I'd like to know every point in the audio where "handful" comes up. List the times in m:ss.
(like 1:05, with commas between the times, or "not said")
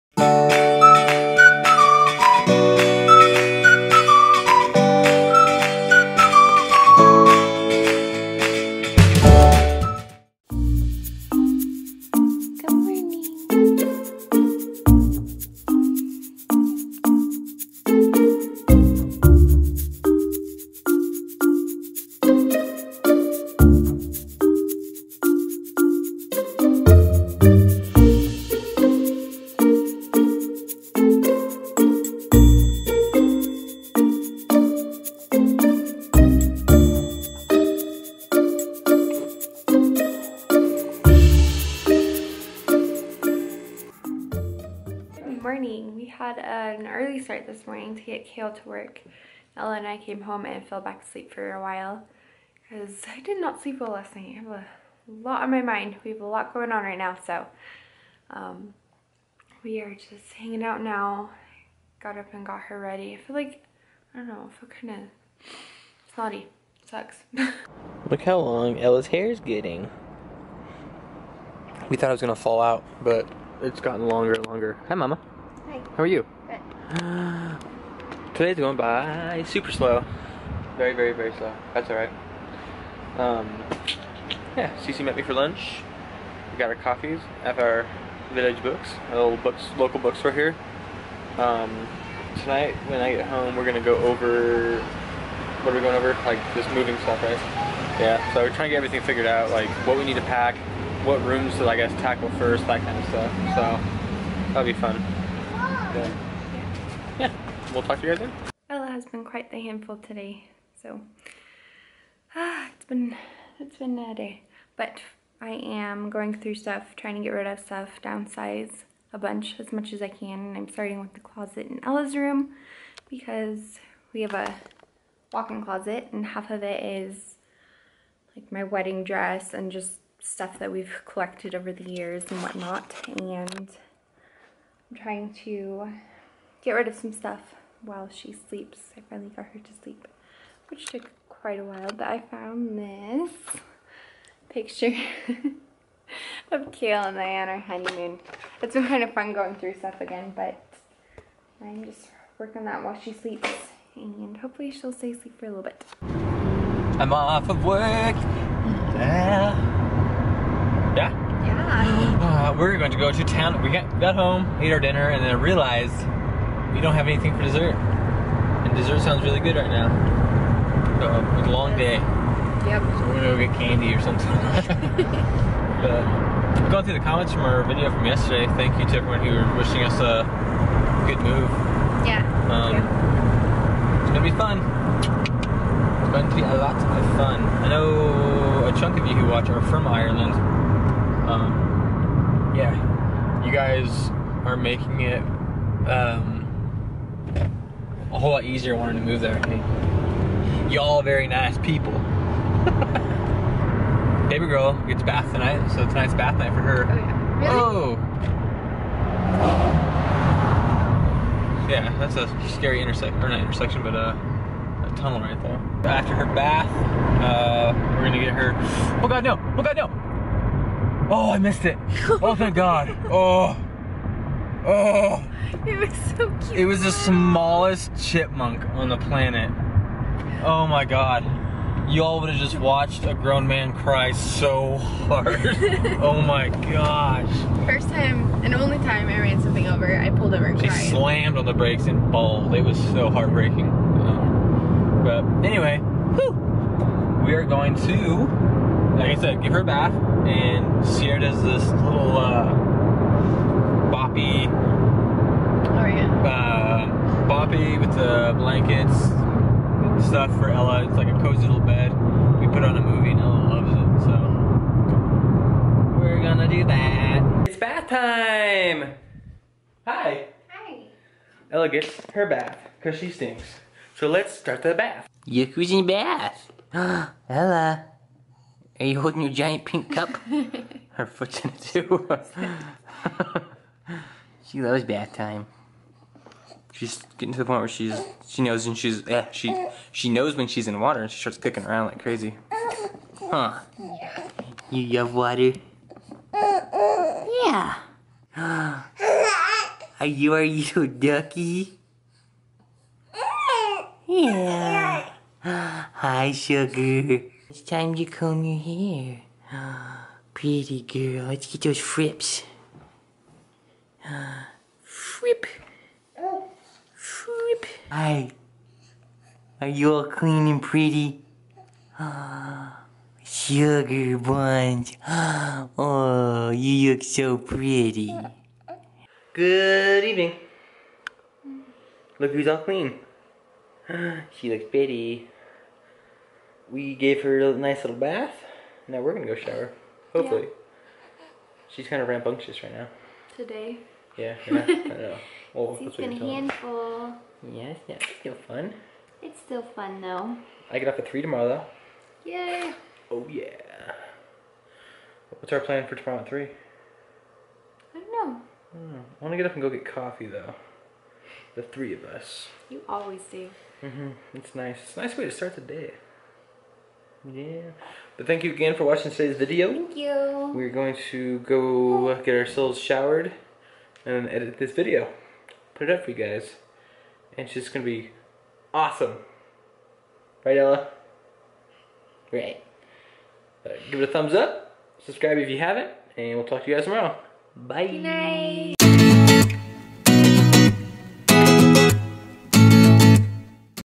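1:49, 5:46.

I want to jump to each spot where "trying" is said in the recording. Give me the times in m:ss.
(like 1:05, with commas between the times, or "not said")
1:38, 1:56, 2:14.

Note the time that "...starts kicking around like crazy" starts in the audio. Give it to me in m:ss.
4:51.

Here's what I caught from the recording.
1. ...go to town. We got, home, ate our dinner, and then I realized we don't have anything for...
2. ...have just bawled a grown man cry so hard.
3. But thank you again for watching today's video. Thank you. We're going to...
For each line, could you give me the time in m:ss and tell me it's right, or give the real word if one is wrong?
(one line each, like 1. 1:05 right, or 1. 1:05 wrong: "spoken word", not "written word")
1. 2:42 right
2. 3:52 wrong: "watched", not "bawled"
3. 6:08 right.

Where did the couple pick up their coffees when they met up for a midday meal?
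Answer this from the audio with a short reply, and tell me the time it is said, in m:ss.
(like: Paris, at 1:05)
Village Books, at 1:28.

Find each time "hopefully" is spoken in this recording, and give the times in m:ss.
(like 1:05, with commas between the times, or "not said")
2:34, 5:40.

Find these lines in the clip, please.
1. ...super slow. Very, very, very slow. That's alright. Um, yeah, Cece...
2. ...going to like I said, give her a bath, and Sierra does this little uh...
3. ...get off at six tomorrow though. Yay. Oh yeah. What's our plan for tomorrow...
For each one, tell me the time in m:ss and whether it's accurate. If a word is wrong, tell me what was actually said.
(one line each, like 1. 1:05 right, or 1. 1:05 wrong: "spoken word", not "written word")
1. 1:19 right
2. 4:07 right
3. 5:50 wrong: "three", not "six".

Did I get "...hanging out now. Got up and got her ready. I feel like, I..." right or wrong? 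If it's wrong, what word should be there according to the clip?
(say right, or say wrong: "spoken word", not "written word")
right.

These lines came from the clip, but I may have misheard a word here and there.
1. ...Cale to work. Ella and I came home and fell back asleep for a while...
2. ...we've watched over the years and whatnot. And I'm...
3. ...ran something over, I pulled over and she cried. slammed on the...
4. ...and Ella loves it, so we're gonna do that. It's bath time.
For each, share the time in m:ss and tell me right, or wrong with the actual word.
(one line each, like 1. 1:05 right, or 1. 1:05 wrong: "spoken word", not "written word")
1. 0:48 right
2. 2:10 wrong: "collected", not "watched"
3. 3:59 right
4. 4:23 right.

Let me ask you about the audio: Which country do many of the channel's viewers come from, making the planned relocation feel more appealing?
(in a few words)
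Ireland.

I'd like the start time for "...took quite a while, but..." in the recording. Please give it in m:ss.
2:20.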